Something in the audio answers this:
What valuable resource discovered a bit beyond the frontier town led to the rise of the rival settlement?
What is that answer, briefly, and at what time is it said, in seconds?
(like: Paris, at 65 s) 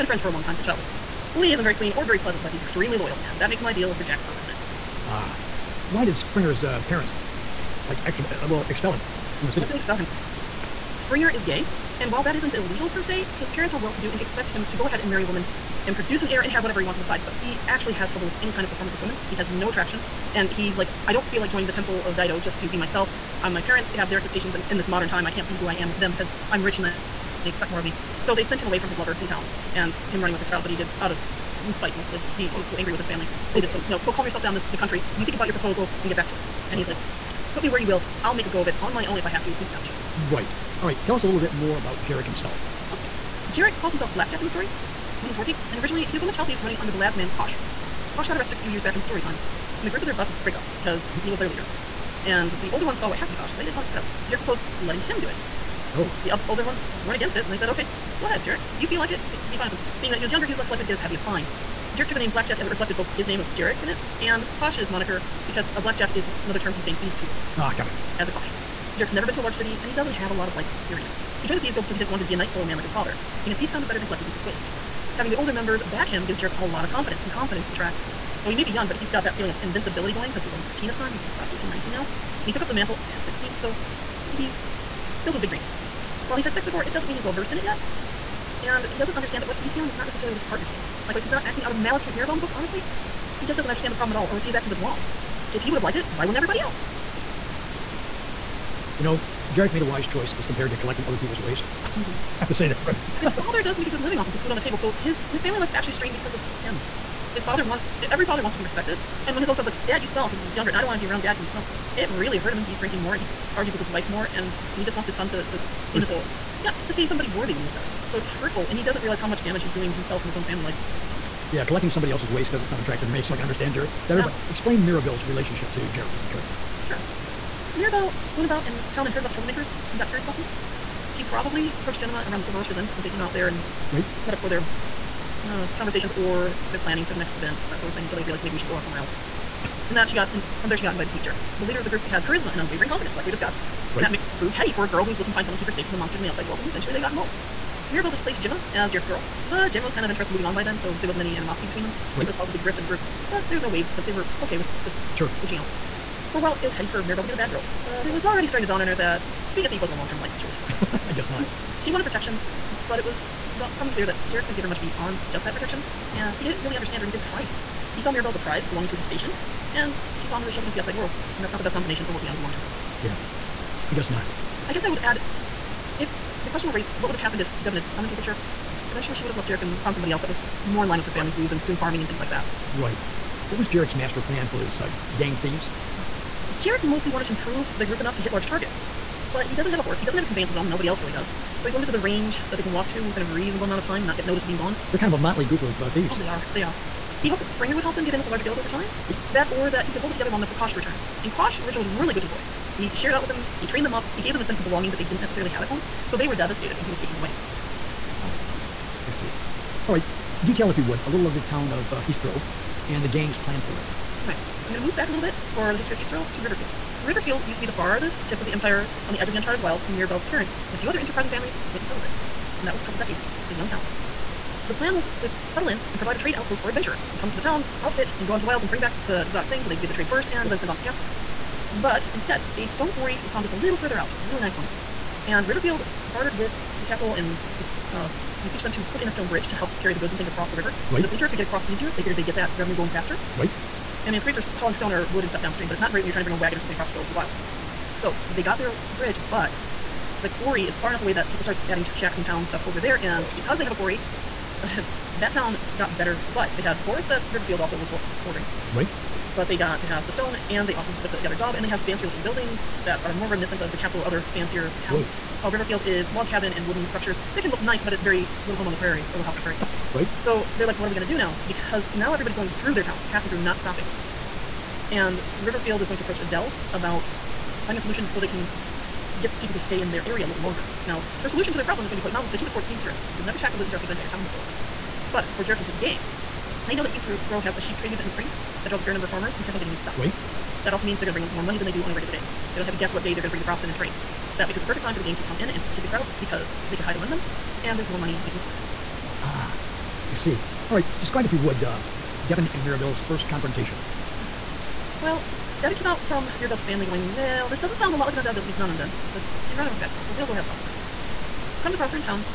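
A stone quarry, at 232 s.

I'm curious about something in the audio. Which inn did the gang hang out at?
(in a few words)
Silver Rushers Inn.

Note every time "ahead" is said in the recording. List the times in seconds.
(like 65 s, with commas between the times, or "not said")
14 s, 58 s.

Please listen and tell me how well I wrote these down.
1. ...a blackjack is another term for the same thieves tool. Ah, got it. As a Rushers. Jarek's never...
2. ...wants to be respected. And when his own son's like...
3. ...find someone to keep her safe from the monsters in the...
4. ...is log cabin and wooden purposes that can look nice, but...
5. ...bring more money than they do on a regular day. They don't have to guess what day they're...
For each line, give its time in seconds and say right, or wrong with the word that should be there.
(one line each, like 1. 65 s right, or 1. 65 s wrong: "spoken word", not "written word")
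1. 65 s wrong: "Kosh", not "Rushers"
2. 108 s right
3. 145 s right
4. 265 s wrong: "structures", not "purposes"
5. 291 s right.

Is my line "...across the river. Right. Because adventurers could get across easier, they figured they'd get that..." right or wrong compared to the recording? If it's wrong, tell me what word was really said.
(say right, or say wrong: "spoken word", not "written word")
right.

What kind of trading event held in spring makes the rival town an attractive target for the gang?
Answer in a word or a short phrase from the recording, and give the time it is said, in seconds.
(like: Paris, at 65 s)
Sheep trading, at 287 s.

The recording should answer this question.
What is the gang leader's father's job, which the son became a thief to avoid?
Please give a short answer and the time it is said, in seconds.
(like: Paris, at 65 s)
Night soil man, at 72 s.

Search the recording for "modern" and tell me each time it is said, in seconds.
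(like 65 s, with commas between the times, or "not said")
24 s.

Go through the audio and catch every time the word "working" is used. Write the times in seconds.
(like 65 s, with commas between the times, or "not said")
45 s, 172 s.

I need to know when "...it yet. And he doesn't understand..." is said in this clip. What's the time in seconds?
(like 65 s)
87 s.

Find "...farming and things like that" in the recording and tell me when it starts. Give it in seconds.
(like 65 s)
181 s.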